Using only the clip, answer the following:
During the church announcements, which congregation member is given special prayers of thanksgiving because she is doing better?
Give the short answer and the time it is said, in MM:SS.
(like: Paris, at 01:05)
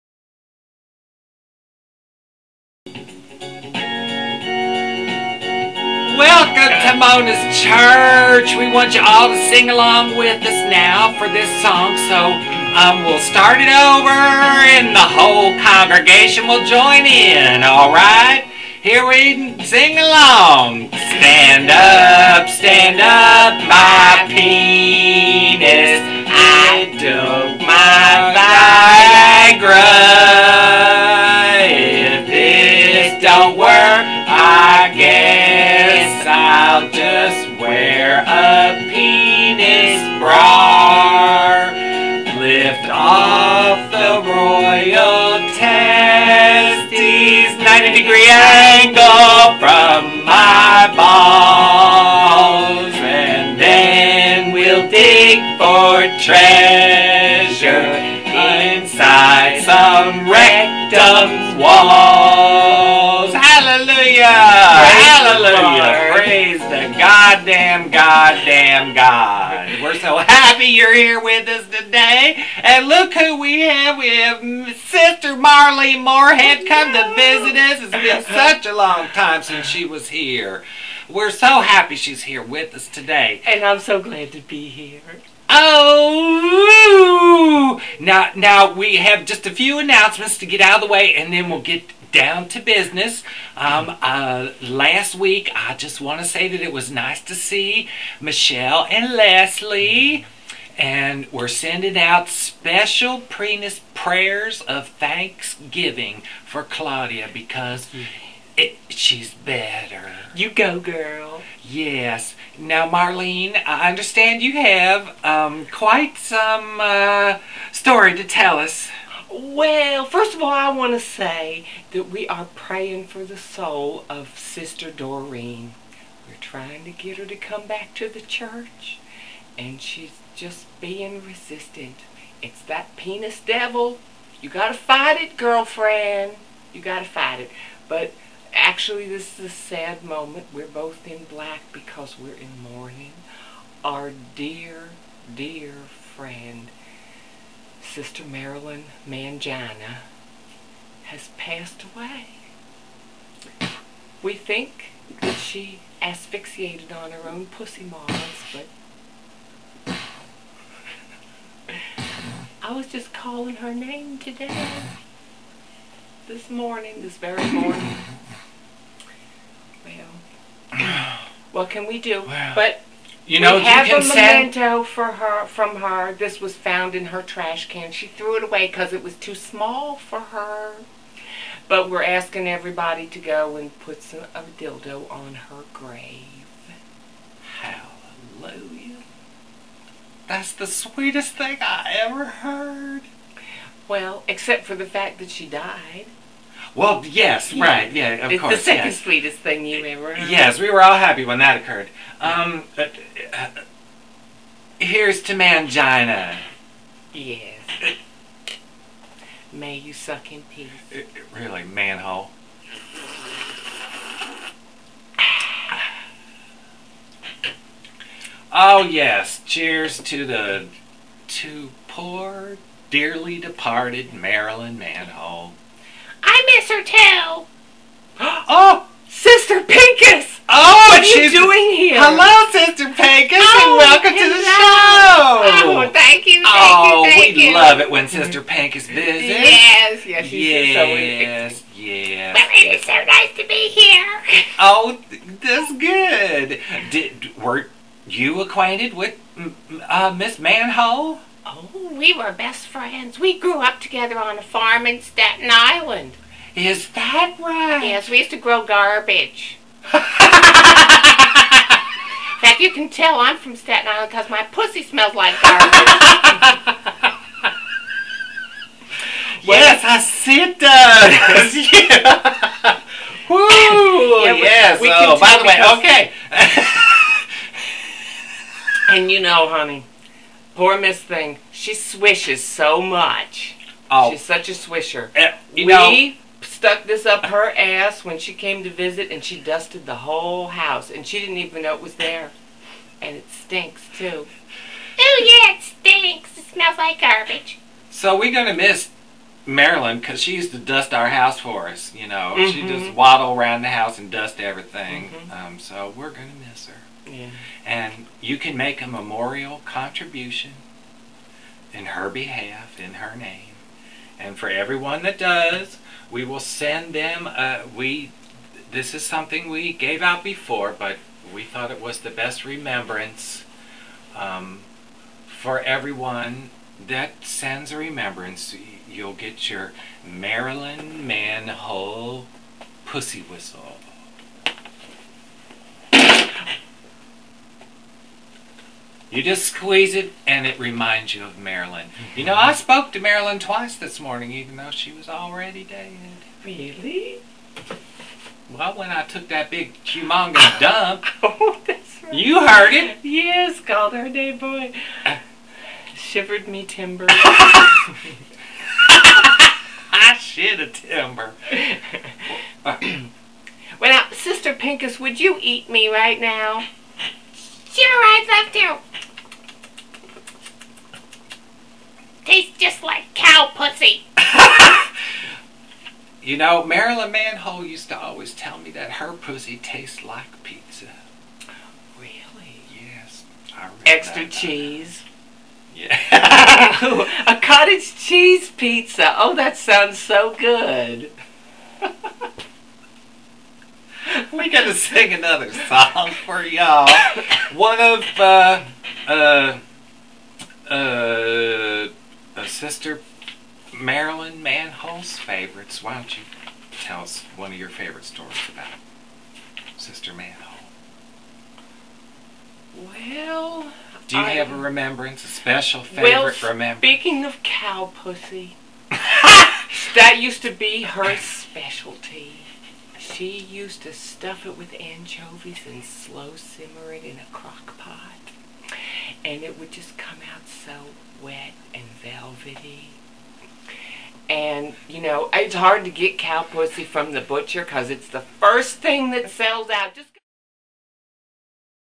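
Claudia, at 01:46.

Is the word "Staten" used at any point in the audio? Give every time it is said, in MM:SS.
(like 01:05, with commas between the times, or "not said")
04:15, 04:23.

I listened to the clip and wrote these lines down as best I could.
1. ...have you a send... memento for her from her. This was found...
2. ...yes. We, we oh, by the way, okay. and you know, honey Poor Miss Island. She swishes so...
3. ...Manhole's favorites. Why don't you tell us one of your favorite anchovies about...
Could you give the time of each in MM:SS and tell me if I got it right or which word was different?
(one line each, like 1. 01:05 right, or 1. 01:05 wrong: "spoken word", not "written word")
1. 02:53 right
2. 04:34 wrong: "Thing", not "Island"
3. 06:44 wrong: "stories", not "anchovies".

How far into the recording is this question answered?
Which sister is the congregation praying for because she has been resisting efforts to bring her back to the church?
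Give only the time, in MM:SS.
02:04.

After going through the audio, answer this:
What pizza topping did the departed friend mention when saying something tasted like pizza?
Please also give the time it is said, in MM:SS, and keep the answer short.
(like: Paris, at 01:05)
Extra cheese, at 06:23.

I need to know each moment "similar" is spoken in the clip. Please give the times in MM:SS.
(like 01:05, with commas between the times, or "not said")
not said.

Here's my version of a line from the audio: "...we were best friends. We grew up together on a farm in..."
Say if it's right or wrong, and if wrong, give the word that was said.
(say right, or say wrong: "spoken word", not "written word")
right.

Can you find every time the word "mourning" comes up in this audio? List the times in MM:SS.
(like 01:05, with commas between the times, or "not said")
02:22.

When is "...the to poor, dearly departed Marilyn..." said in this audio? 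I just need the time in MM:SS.
03:40.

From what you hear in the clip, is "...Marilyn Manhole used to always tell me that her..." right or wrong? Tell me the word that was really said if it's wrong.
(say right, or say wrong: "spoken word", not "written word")
right.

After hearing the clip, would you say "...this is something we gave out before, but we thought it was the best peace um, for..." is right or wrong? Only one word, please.
wrong.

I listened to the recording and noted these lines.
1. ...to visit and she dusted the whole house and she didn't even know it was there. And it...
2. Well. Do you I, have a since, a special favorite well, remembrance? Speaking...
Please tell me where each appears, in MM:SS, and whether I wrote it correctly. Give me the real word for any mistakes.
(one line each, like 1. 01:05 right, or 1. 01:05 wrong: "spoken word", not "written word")
1. 04:48 right
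2. 06:52 wrong: "remembrance", not "since".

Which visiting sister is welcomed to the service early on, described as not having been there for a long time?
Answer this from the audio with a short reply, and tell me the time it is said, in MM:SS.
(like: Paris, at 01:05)
Marley Moorhead, at 01:14.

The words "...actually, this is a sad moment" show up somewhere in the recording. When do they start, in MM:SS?
02:18.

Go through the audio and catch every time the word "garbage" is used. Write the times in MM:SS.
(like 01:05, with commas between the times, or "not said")
04:18, 04:25, 04:57.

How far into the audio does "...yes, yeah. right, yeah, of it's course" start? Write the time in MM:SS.
03:17.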